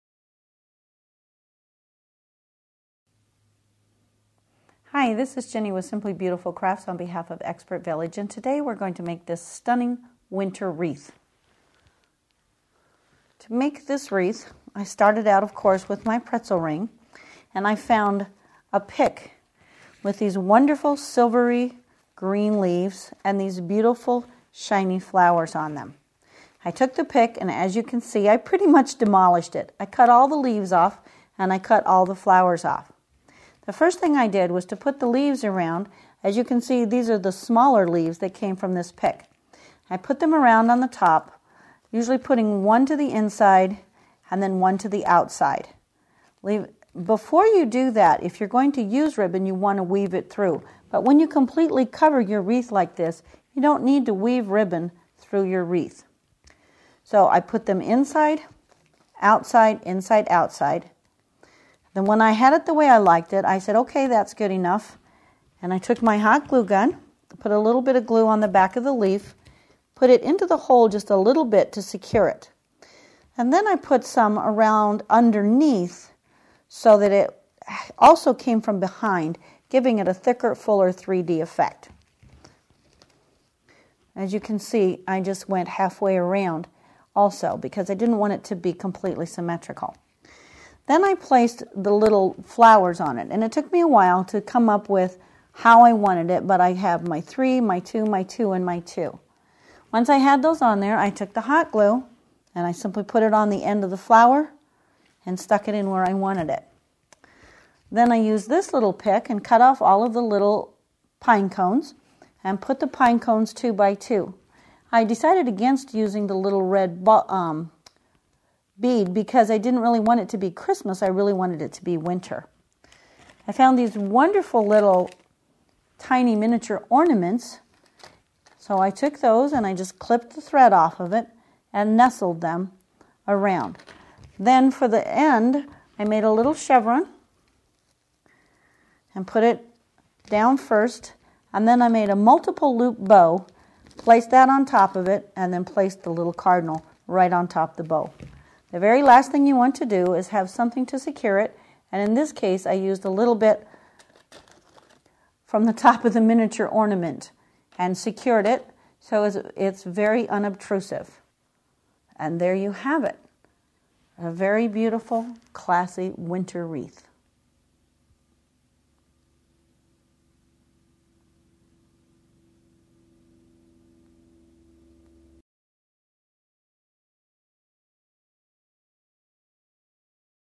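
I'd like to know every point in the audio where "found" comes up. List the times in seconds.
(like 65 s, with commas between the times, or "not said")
17 s, 123 s.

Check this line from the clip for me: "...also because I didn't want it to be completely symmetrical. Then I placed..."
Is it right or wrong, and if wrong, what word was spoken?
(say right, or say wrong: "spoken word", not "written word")
right.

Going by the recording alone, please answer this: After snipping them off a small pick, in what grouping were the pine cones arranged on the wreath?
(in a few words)
two by two.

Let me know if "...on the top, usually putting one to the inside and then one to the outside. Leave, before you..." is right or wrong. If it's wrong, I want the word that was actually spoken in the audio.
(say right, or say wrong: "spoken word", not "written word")
right.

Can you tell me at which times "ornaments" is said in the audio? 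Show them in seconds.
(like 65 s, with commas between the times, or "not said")
126 s, 156 s.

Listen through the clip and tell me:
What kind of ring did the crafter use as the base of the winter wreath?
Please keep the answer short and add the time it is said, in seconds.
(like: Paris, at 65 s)
pretzel ring, at 16 s.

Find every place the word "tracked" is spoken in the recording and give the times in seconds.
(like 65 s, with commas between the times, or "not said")
not said.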